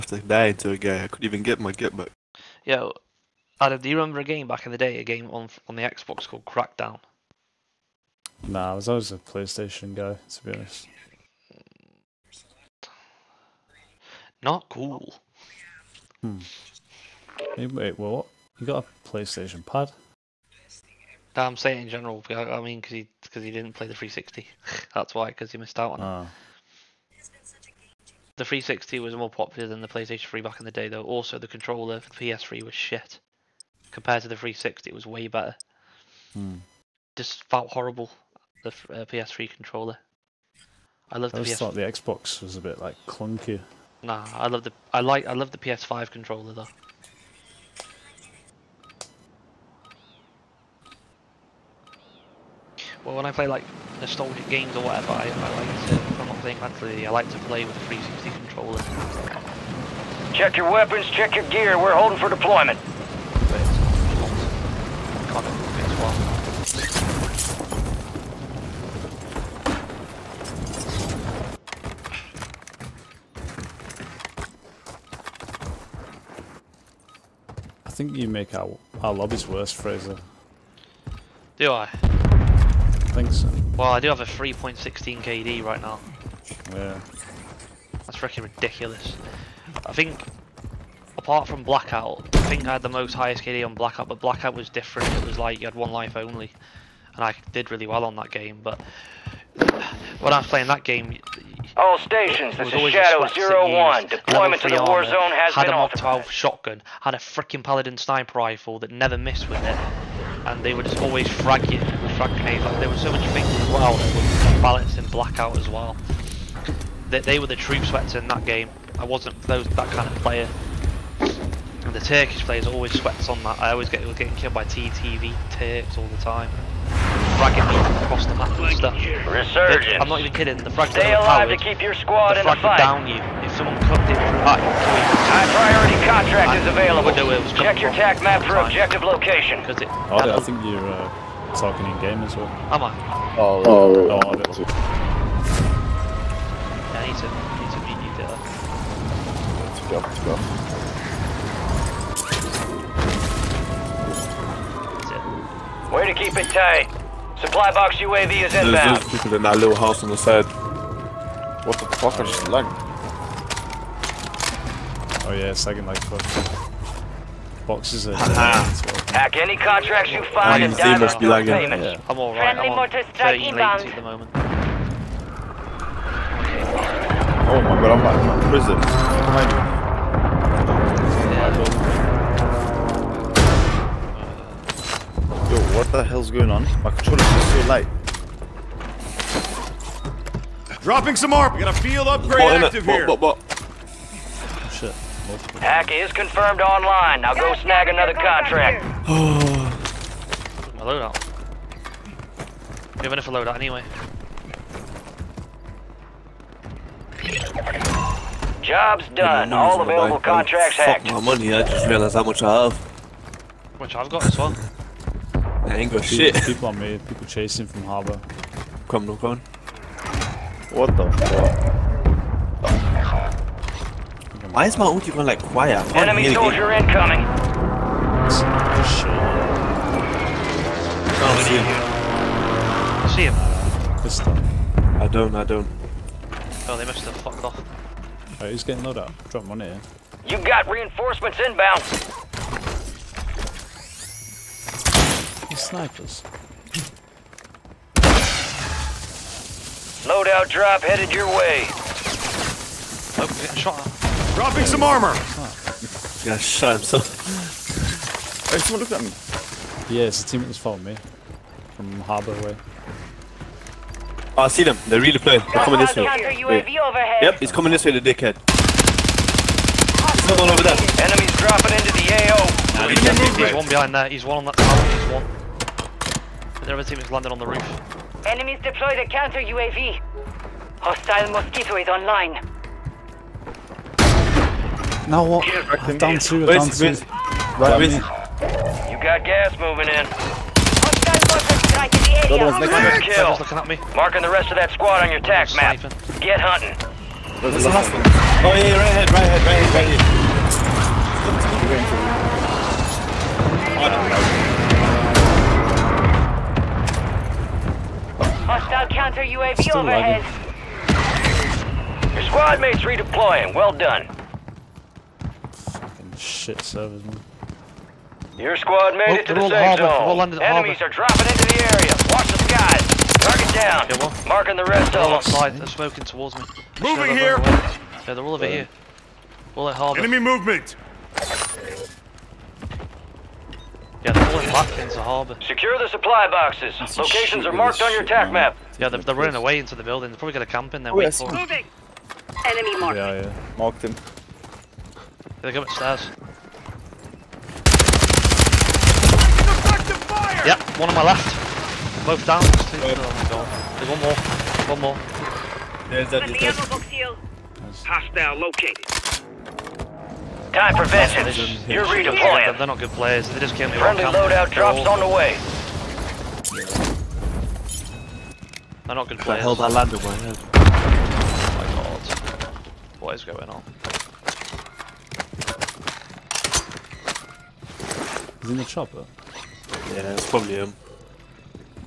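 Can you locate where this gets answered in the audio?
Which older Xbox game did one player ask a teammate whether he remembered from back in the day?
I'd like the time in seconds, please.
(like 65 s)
6 s.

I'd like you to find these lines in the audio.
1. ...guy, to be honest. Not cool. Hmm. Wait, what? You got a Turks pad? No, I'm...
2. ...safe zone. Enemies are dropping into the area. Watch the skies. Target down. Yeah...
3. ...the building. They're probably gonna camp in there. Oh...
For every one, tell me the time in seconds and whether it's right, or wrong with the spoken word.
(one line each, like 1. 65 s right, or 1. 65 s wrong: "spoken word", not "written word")
1. 9 s wrong: "PlayStation", not "Turks"
2. 319 s right
3. 339 s right.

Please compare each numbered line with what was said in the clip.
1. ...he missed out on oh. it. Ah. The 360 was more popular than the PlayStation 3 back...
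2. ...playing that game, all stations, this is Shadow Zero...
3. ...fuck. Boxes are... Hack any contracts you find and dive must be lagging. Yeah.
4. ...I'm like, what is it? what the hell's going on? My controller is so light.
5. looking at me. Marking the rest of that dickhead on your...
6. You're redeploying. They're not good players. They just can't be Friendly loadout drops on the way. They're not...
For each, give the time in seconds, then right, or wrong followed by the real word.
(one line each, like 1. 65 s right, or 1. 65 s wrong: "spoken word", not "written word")
1. 25 s right
2. 100 s right
3. 166 s right
4. 177 s right
5. 293 s wrong: "squad", not "dickhead"
6. 361 s right.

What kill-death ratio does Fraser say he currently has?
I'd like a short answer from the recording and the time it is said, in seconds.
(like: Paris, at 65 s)
3.16, at 84 s.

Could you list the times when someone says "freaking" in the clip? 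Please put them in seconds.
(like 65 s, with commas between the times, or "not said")
88 s, 107 s.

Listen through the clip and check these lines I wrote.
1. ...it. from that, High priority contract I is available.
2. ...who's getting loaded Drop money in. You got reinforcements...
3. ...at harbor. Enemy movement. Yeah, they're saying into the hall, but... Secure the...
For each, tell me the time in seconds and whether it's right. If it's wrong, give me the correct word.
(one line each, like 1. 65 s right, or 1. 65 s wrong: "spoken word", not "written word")
1. 134 s right
2. 238 s right
3. 329 s wrong: "pulling", not "saying".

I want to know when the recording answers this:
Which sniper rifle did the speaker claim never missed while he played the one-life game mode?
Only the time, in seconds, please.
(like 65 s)
107 s.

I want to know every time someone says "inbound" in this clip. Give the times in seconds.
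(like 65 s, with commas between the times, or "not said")
158 s, 241 s.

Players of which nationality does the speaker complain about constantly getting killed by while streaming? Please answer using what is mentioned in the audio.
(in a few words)
Turkish.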